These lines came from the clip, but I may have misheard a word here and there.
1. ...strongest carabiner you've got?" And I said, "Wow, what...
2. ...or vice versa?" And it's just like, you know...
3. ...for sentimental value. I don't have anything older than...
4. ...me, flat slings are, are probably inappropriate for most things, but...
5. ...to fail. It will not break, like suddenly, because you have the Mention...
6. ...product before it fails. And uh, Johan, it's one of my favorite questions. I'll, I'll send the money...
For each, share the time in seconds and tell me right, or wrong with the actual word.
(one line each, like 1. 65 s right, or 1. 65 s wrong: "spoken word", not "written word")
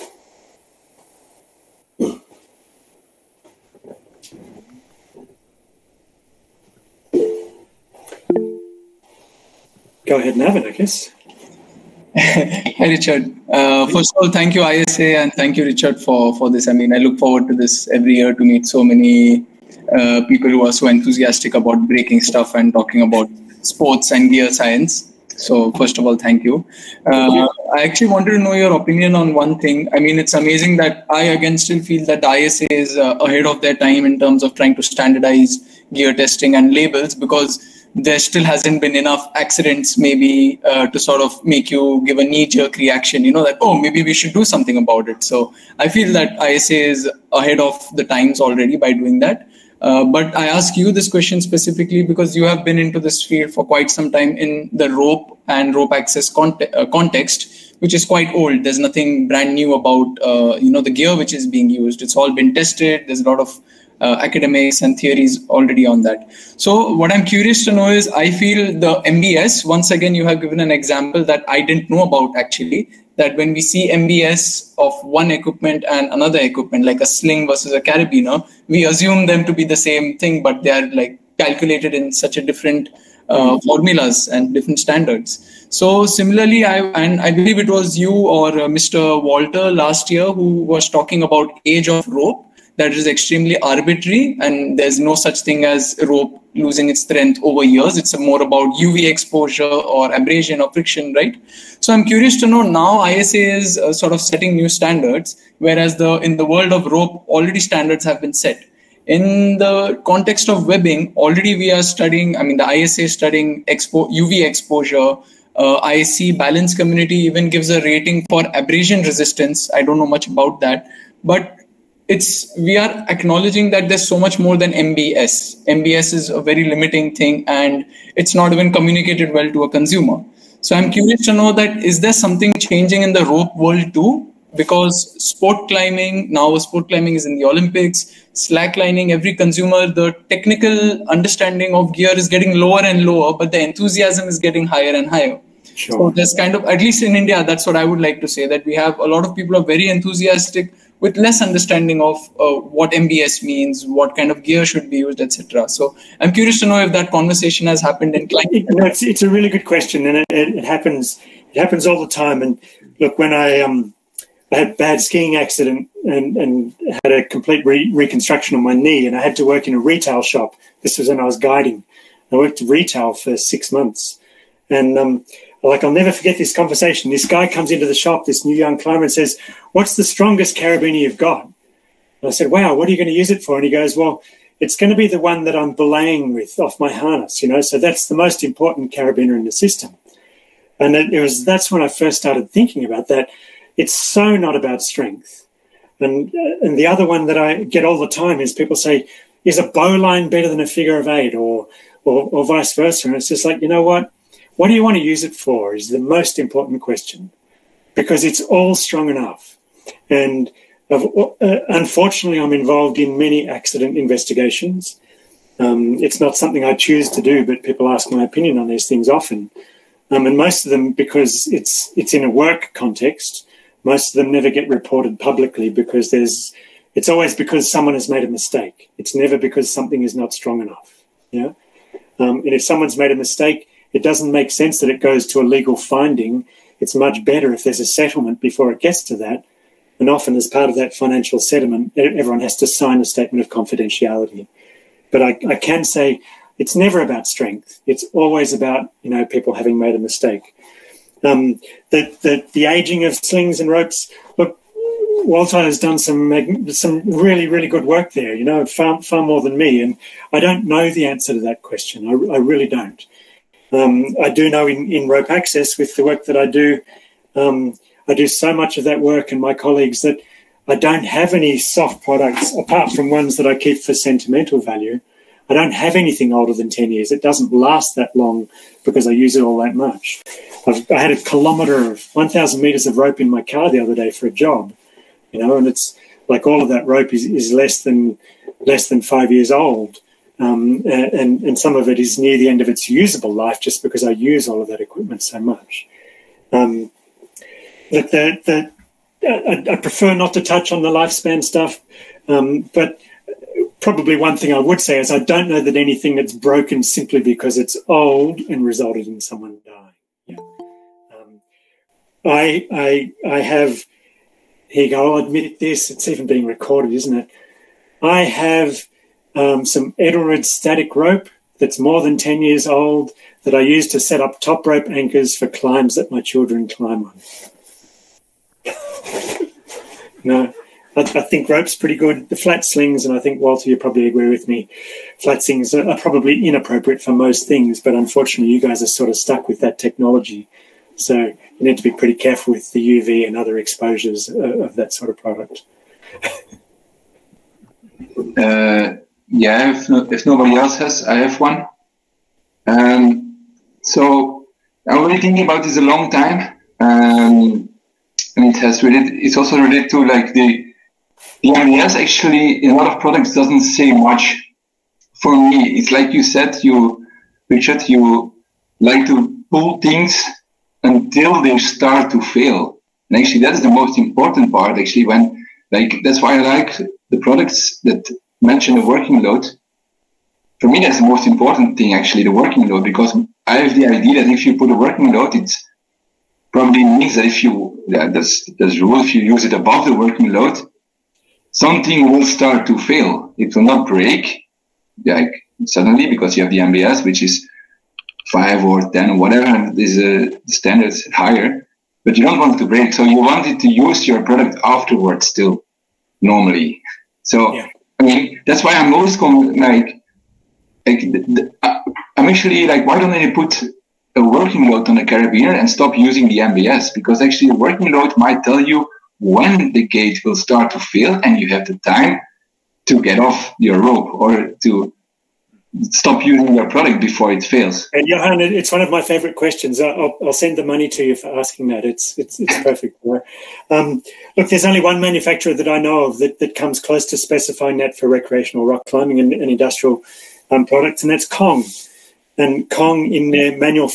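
1. 180 s right
2. 202 s right
3. 273 s right
4. 334 s right
5. 392 s wrong: "MBS", not "Mention"
6. 426 s right.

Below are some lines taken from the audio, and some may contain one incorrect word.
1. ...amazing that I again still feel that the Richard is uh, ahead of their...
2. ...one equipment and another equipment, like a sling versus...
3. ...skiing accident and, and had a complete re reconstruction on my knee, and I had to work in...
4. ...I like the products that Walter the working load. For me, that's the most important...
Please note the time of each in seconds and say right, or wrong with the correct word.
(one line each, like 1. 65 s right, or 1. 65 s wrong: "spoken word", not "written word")
1. 30 s wrong: "ISA", not "Richard"
2. 75 s right
3. 165 s right
4. 376 s wrong: "Mention", not "Walter".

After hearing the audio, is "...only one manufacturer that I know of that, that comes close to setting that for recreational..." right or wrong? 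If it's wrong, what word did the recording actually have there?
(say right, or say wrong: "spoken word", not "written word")
wrong: "specifying", not "setting".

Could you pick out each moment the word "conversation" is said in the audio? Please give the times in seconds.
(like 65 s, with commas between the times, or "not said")
157 s, 176 s.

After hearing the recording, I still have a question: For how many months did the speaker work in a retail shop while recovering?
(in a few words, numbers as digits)
6.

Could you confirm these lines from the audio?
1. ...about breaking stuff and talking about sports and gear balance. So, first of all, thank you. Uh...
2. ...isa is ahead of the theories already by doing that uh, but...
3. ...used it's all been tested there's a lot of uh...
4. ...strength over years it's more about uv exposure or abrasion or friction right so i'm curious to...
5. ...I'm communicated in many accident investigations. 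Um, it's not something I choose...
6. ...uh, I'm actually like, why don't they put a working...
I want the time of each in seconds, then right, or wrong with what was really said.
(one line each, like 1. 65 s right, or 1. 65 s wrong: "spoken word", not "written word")
1. 21 s wrong: "science", not "balance"
2. 46 s wrong: "times", not "theories"
3. 61 s right
4. 97 s right
5. 212 s wrong: "involved", not "communicated"
6. 411 s right.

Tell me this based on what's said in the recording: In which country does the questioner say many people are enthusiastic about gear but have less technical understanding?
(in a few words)
India.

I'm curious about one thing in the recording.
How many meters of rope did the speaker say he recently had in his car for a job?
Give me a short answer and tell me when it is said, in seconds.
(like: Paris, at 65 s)
1,000, at 282 s.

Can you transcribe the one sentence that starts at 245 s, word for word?
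But I, I can say it's never about strength.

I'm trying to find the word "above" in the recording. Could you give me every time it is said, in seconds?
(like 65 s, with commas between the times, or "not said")
389 s.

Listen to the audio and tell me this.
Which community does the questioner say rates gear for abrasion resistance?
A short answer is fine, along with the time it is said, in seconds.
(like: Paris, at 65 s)
IC balance community, at 115 s.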